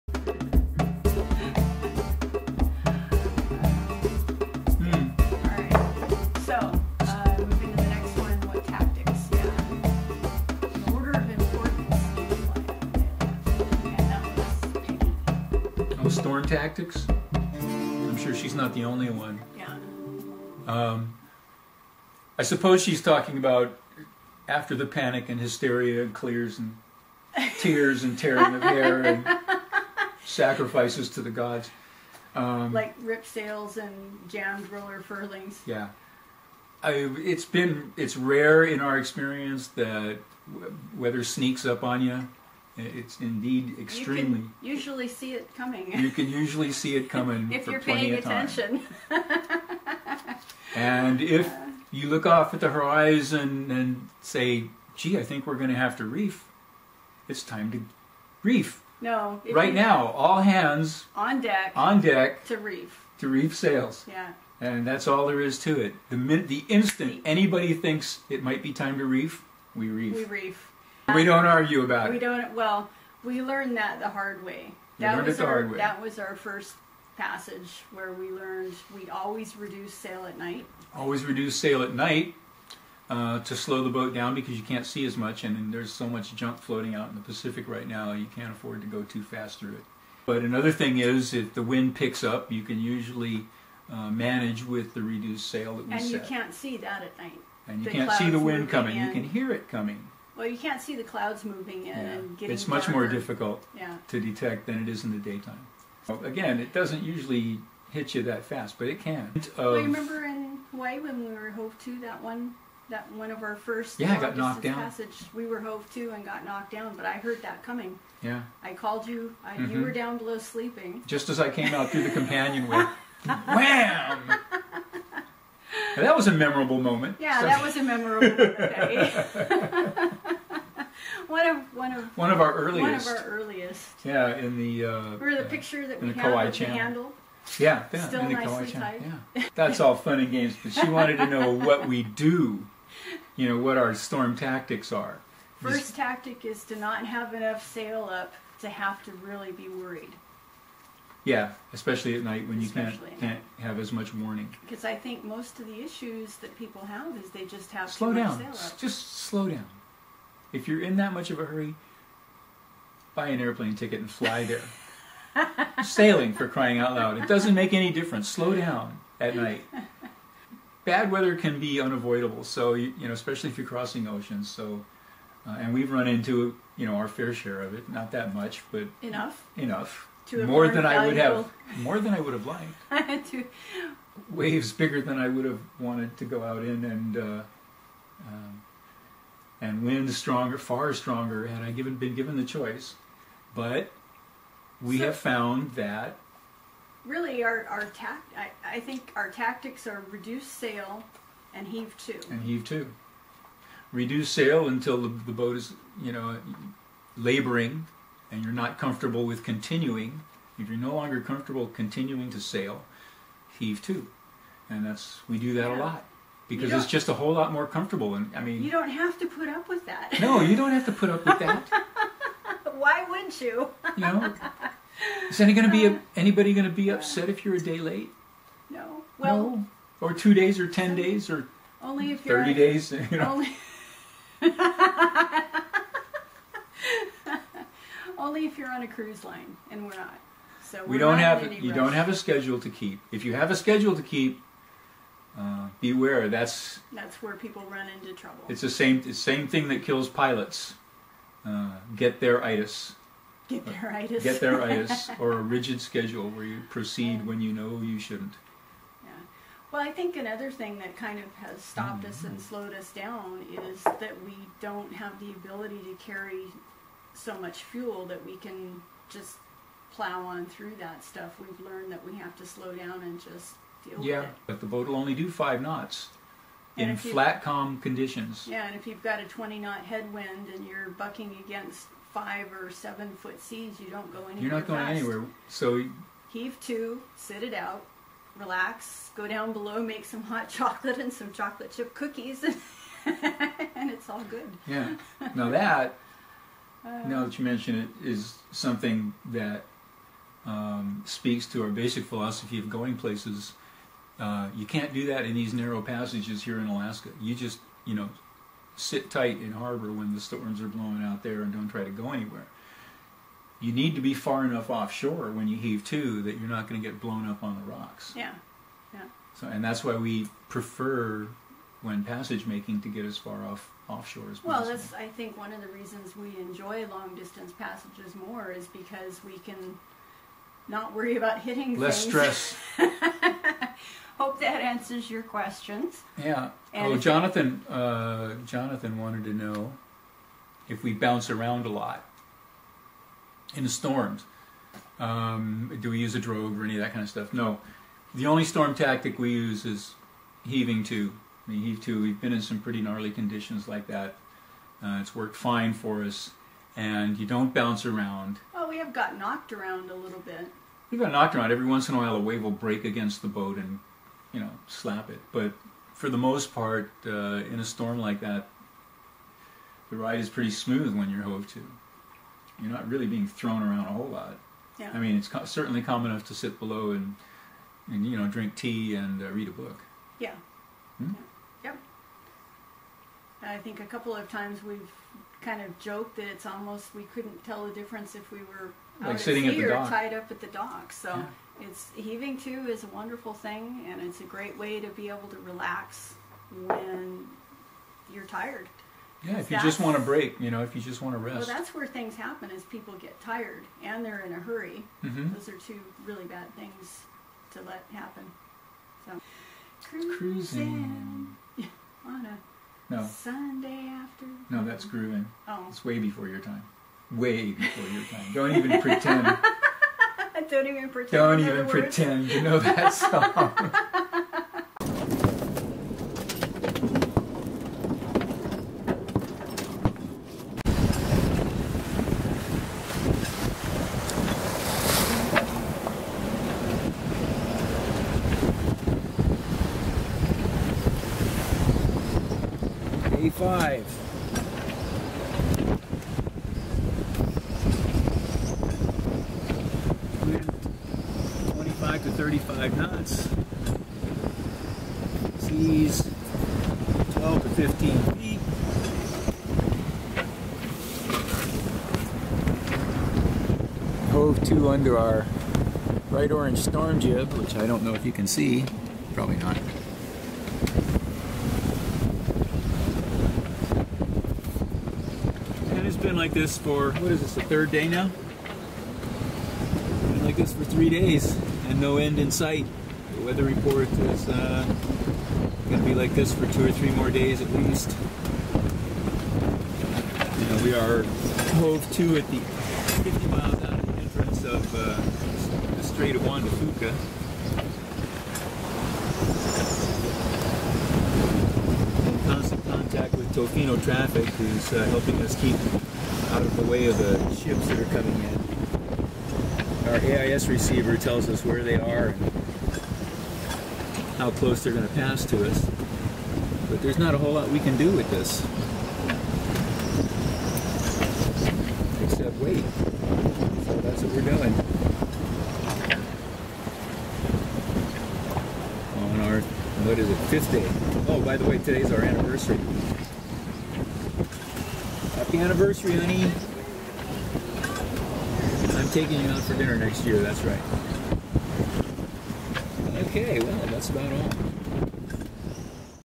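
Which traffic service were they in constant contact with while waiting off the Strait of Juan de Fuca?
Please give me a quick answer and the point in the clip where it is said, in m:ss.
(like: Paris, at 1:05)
Tofino traffic, at 8:23.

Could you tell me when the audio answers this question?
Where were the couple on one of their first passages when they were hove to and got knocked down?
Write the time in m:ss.
1:50.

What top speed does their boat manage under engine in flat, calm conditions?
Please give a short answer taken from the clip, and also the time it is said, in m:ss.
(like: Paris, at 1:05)
5 knots, at 4:35.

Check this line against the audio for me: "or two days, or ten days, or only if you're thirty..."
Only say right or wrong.
right.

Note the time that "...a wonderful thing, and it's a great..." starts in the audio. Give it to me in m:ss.
6:32.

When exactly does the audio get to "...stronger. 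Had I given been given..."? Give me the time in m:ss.
3:10.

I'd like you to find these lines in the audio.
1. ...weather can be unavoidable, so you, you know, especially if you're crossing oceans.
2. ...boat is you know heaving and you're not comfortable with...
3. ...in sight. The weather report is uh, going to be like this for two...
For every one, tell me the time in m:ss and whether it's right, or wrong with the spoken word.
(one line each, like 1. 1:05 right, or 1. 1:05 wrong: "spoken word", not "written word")
1. 2:51 right
2. 3:25 wrong: "laboring", not "heaving"
3. 8:02 right.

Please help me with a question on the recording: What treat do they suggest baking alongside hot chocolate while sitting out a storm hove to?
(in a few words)
Chocolate chip cookies.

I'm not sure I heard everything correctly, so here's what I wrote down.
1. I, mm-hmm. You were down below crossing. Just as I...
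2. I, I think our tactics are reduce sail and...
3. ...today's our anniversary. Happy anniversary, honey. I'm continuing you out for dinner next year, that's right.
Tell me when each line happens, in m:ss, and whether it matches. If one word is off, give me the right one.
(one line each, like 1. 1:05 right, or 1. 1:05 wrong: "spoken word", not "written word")
1. 1:59 wrong: "sleeping", not "crossing"
2. 3:18 right
3. 8:51 wrong: "taking", not "continuing".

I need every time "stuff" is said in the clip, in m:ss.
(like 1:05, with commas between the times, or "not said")
4:31, 5:47.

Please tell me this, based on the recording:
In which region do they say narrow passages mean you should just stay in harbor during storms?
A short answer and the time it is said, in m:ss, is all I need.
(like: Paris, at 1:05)
Alaska, at 5:06.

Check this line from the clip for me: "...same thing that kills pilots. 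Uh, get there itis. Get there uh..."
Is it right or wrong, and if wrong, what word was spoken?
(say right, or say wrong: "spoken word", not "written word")
right.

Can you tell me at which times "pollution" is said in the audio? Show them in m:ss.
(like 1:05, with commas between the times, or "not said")
not said.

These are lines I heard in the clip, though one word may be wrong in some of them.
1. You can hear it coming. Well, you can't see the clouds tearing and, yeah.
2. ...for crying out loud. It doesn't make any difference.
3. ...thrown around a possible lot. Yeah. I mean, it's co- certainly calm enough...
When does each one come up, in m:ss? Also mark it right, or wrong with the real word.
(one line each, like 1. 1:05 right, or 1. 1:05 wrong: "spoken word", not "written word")
1. 1:39 wrong: "moving", not "tearing"
2. 2:46 right
3. 6:13 wrong: "whole", not "possible".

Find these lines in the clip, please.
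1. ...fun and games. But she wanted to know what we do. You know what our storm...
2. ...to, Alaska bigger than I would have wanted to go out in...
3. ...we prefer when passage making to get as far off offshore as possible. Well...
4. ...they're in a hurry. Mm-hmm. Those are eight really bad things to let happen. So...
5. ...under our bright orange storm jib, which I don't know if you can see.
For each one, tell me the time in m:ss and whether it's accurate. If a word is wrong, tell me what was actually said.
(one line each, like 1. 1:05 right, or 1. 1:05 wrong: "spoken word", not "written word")
1. 2:19 right
2. 3:03 wrong: "Waves", not "Alaska"
3. 5:19 right
4. 6:44 wrong: "two", not "eight"
5. 7:44 right.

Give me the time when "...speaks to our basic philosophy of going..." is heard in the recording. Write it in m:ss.
5:01.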